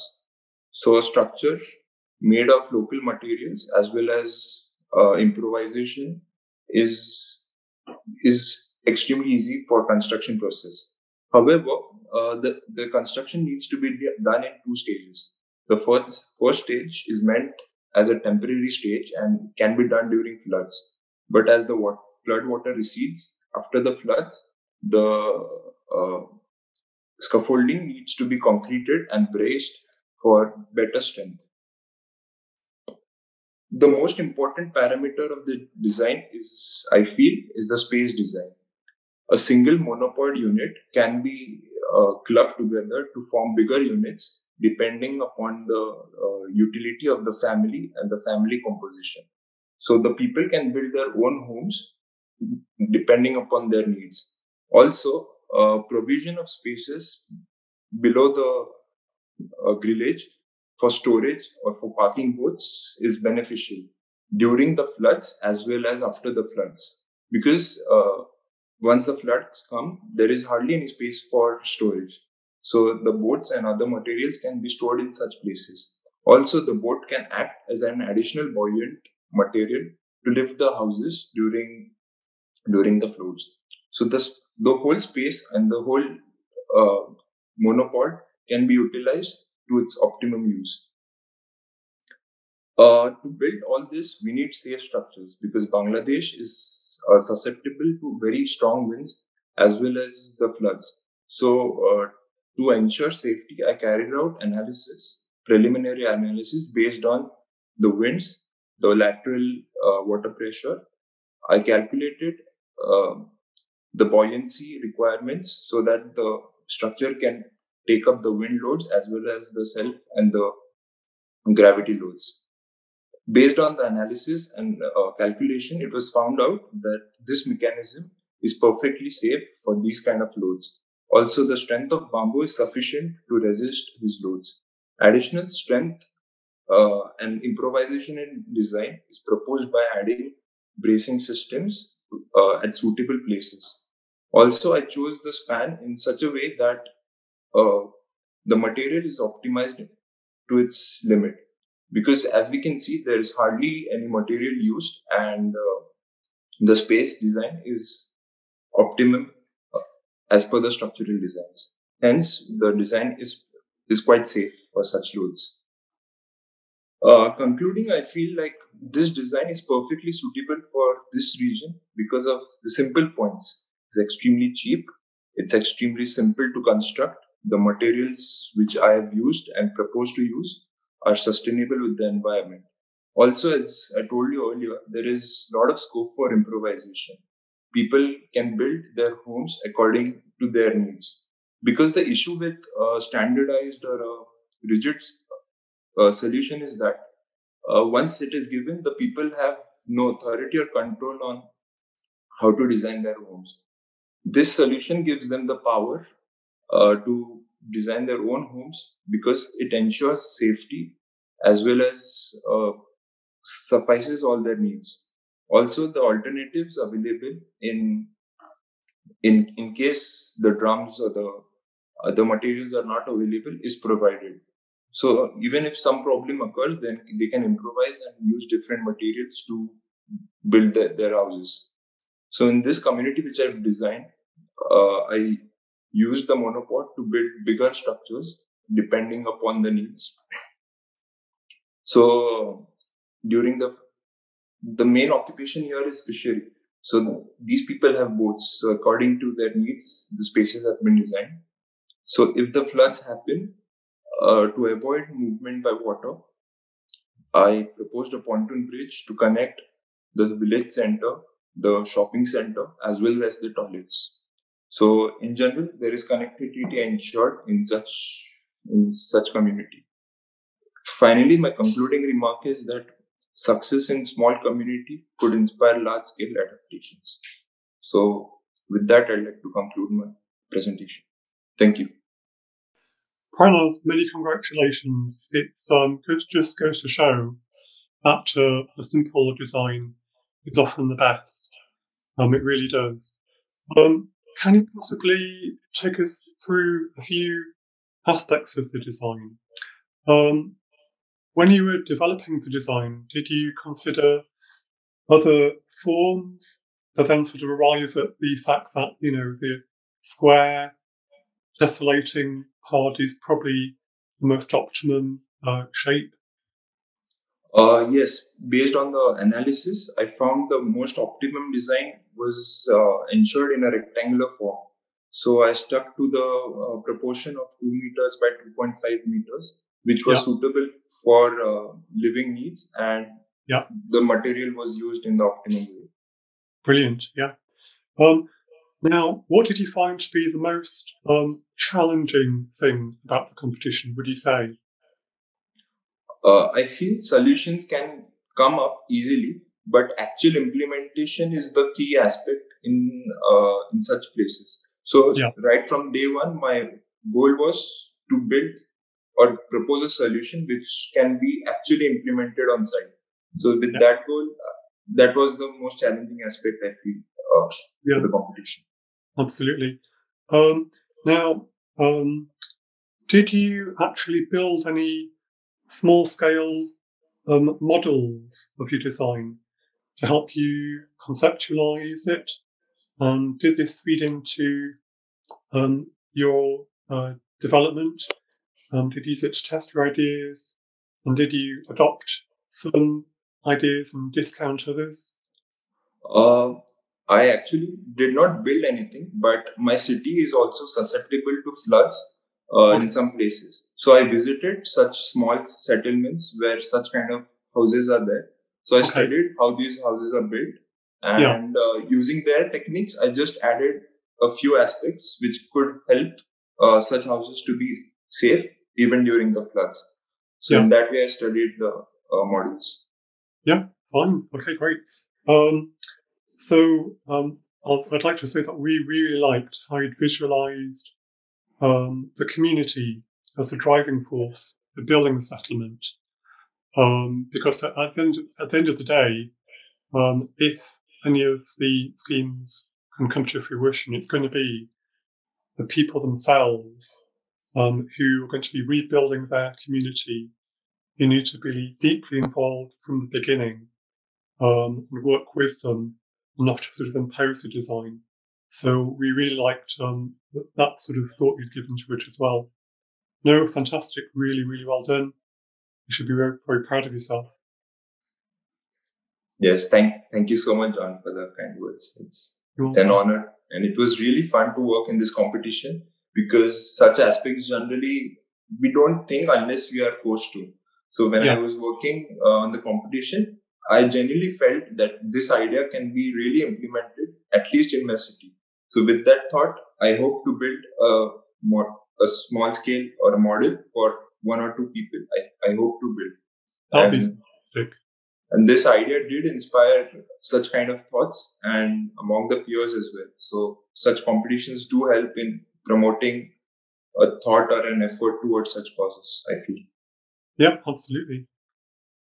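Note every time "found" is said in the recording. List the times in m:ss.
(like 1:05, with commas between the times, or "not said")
2:06, 5:20.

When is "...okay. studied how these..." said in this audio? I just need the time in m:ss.
6:48.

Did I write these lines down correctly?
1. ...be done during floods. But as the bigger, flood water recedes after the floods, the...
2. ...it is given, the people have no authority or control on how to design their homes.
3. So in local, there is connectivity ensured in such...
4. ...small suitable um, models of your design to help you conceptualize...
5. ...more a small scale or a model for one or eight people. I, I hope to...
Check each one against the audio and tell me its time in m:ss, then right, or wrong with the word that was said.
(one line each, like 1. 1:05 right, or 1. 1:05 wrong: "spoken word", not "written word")
1. 0:19 wrong: "water", not "bigger"
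2. 3:18 right
3. 4:24 wrong: "general", not "local"
4. 6:15 wrong: "scale", not "suitable"
5. 8:11 wrong: "two", not "eight".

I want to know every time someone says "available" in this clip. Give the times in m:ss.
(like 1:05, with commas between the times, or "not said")
3:36, 3:43.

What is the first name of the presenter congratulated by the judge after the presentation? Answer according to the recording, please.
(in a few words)
Pranav.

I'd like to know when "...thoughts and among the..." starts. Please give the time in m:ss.
8:20.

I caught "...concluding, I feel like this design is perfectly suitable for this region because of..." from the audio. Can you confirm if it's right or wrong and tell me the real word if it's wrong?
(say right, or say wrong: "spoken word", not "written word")
right.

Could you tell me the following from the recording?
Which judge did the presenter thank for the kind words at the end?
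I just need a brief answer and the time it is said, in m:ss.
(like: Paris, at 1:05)
John, at 7:50.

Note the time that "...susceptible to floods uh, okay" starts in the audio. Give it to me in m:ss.
6:40.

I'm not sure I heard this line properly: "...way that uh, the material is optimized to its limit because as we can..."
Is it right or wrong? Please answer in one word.
right.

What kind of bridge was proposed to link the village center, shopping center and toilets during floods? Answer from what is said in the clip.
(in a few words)
pontoon bridge.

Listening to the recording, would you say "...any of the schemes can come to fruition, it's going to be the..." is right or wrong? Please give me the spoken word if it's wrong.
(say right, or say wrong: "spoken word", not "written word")
right.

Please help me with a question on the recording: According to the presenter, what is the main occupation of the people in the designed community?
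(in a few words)
fishery.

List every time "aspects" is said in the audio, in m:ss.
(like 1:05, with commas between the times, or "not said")
4:58, 5:51, 6:06, 6:54, 7:57.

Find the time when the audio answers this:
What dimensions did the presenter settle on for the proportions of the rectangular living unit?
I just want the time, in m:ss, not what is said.
5:27.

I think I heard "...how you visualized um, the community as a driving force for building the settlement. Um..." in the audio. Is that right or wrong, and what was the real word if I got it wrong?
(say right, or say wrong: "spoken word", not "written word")
right.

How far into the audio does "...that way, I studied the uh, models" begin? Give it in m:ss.
7:00.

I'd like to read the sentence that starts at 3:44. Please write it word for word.
So even if some problem occurs, then they can improvise and use different materials to build the, their houses.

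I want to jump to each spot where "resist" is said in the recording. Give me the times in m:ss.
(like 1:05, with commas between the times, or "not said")
2:13.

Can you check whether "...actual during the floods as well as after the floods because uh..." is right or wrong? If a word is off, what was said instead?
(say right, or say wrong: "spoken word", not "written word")
wrong: "beneficial", not "actual".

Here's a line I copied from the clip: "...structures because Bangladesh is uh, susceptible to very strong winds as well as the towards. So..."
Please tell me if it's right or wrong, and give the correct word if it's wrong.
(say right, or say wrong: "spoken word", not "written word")
wrong: "floods", not "towards".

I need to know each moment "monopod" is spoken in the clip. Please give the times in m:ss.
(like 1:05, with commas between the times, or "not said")
0:39, 1:27, 3:56.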